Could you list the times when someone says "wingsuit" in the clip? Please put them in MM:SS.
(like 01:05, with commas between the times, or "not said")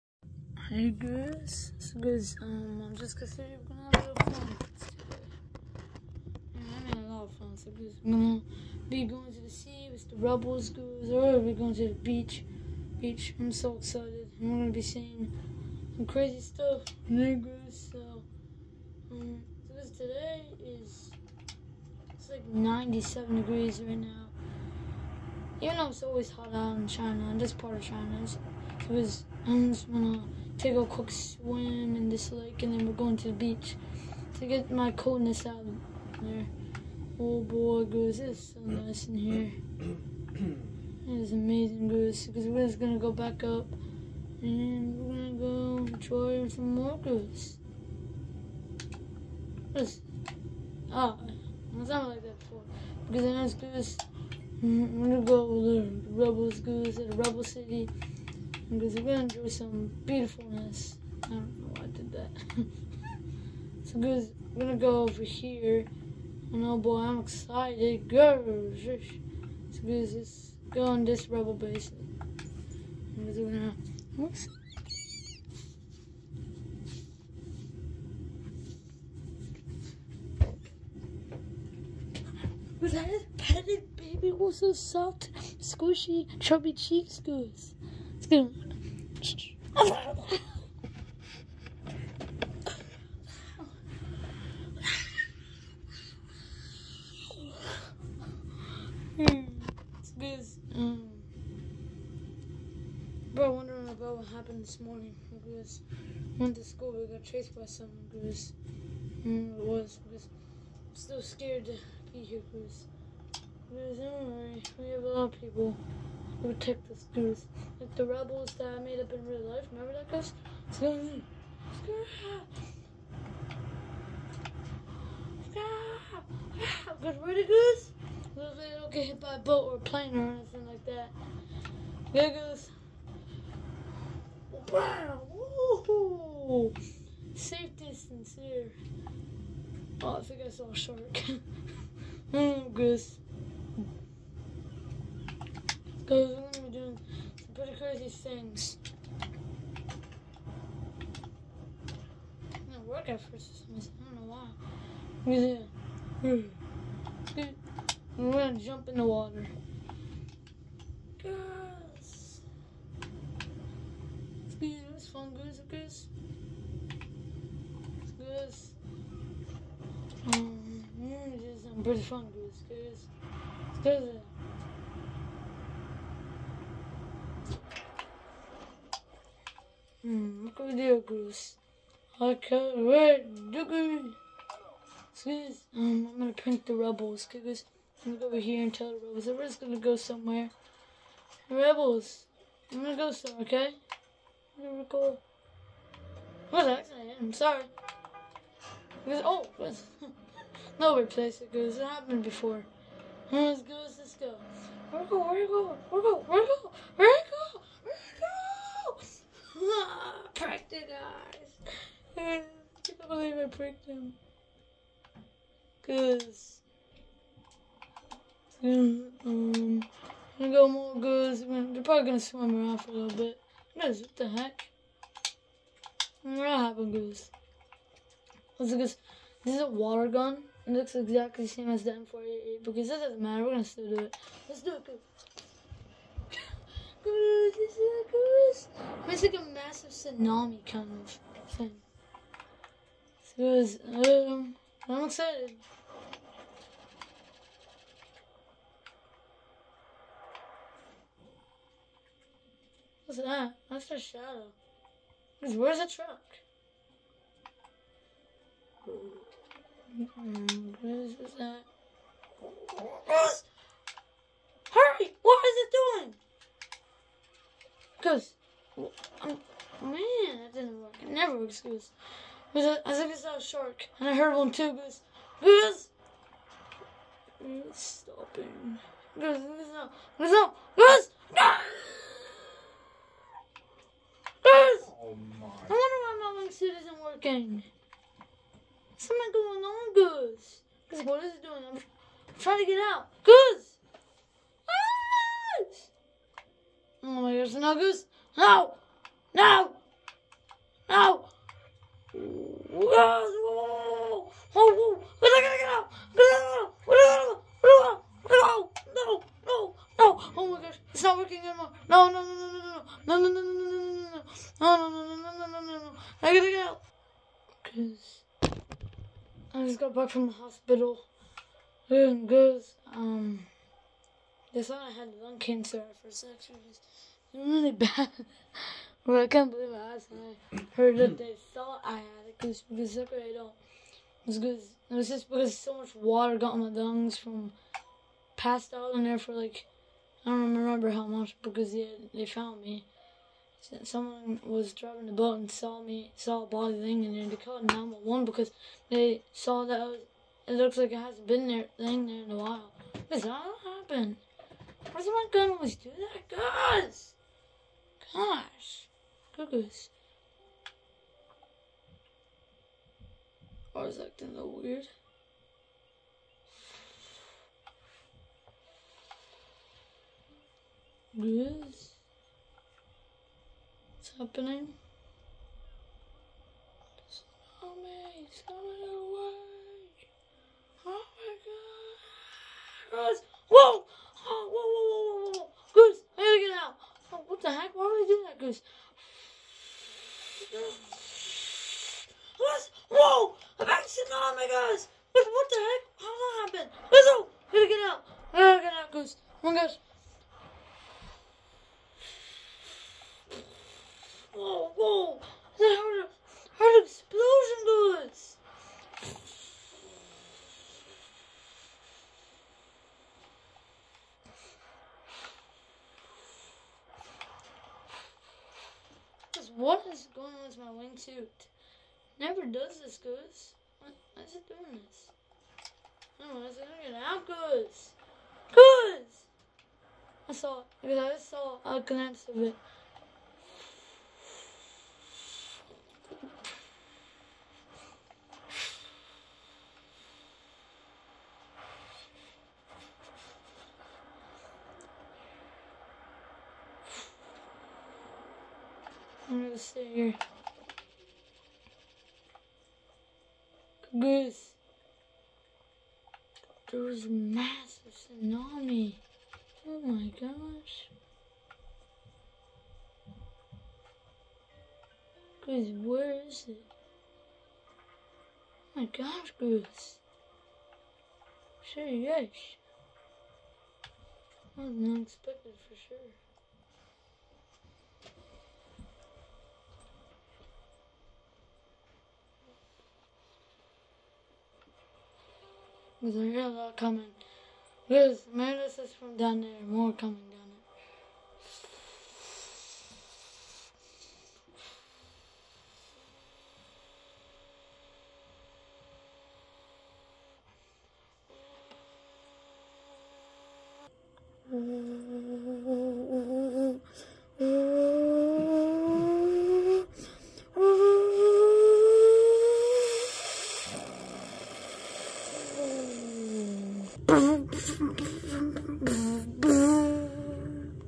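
04:46, 07:00.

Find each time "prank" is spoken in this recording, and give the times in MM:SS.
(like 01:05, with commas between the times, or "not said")
03:06.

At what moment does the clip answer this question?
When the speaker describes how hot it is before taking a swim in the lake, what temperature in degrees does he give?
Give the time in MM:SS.
00:22.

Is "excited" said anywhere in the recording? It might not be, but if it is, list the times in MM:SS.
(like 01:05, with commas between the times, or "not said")
00:13, 01:07, 04:05.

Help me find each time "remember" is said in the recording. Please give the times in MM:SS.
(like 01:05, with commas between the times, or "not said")
01:59, 05:40.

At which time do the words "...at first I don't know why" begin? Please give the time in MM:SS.
02:33.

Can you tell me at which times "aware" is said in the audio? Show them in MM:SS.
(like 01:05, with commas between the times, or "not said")
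not said.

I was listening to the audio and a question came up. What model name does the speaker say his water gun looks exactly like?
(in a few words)
M488.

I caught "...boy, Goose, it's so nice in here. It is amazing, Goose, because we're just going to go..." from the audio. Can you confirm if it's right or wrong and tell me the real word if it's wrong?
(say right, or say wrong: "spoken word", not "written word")
right.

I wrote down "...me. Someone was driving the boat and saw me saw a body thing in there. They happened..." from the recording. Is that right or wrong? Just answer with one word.
wrong.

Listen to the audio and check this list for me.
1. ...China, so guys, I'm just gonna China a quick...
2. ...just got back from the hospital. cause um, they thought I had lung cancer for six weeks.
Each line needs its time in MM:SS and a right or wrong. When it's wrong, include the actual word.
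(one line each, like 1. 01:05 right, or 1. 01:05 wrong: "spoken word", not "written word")
1. 00:27 wrong: "Take", not "China"
2. 05:19 right.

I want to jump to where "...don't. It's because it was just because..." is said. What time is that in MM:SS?
05:33.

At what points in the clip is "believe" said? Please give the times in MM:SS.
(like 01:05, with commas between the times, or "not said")
03:33, 05:29.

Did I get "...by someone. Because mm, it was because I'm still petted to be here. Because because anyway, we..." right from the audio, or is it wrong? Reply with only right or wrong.
wrong.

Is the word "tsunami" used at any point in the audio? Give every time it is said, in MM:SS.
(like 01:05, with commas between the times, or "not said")
03:59, 07:37.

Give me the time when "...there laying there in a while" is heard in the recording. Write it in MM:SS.
05:51.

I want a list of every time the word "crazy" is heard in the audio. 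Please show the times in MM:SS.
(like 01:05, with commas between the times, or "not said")
00:16, 02:27.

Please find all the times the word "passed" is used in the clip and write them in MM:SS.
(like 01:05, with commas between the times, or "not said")
05:38.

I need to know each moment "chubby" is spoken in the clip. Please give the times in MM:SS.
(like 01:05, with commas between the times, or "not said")
01:26.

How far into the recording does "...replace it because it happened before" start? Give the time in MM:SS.
03:20.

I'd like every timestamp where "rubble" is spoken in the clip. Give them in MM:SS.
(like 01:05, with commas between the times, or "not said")
01:11.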